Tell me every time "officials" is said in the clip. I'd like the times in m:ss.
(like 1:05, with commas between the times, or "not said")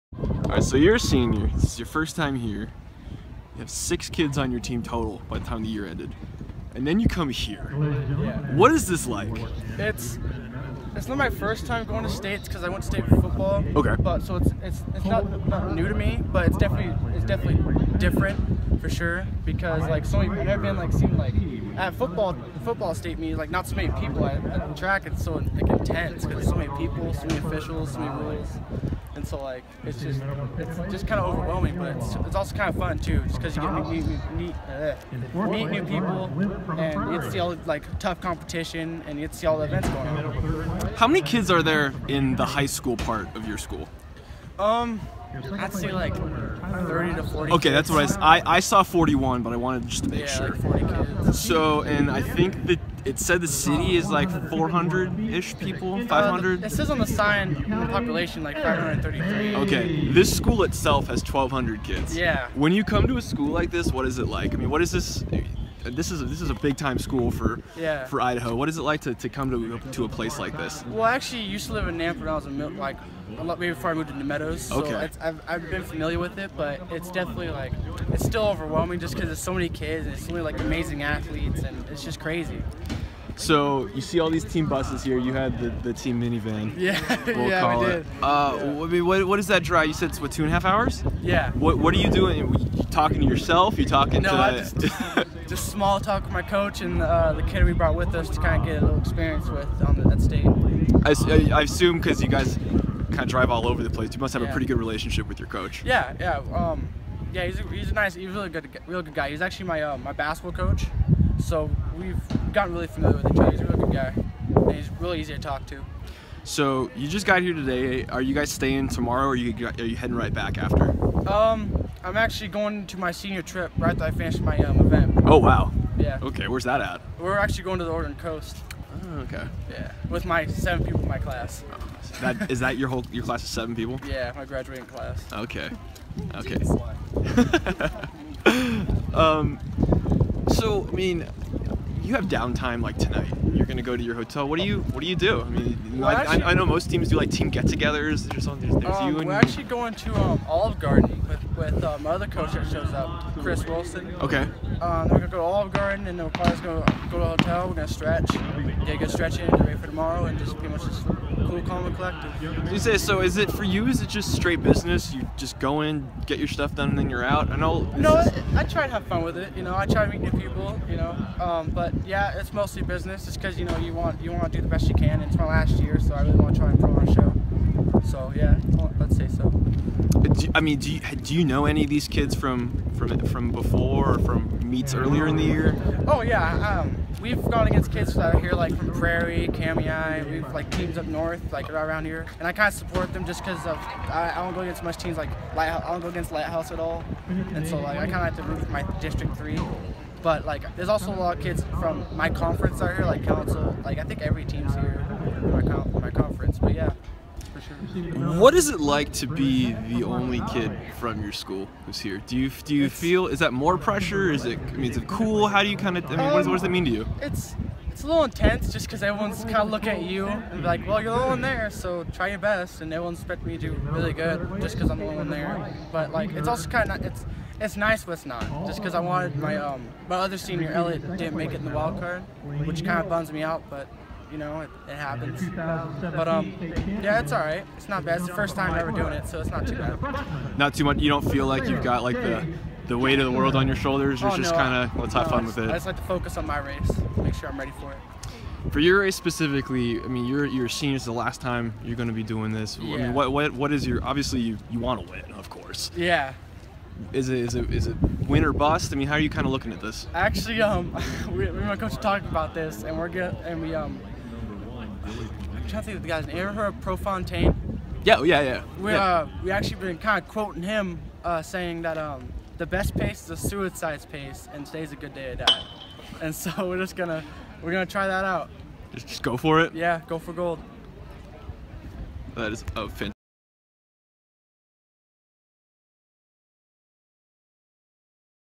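0:27.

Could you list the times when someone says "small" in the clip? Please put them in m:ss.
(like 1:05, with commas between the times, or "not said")
1:35.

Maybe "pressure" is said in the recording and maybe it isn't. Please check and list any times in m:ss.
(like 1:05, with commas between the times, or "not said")
3:33.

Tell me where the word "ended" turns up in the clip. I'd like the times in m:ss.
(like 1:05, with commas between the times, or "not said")
0:05.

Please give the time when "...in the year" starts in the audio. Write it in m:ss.
3:05.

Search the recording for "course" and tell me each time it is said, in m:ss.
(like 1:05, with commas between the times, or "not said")
4:15.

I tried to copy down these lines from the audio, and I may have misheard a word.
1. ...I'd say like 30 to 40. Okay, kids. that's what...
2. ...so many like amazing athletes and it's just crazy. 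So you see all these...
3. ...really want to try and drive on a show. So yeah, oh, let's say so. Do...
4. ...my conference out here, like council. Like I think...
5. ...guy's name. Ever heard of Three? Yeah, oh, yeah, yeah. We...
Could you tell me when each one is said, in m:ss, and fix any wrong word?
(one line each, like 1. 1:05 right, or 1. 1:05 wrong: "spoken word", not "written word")
1. 0:45 right
2. 1:20 right
3. 2:56 wrong: "improve", not "drive"
4. 3:22 right
5. 4:26 wrong: "Prefontaine", not "Three".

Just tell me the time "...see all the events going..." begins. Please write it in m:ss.
0:39.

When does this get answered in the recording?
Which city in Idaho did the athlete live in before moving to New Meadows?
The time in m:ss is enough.
1:11.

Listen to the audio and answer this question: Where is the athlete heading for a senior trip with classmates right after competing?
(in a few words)
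The Oregon coast.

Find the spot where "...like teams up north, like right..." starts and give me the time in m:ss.
3:10.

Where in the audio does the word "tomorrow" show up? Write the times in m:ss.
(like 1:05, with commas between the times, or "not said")
1:58, 2:39.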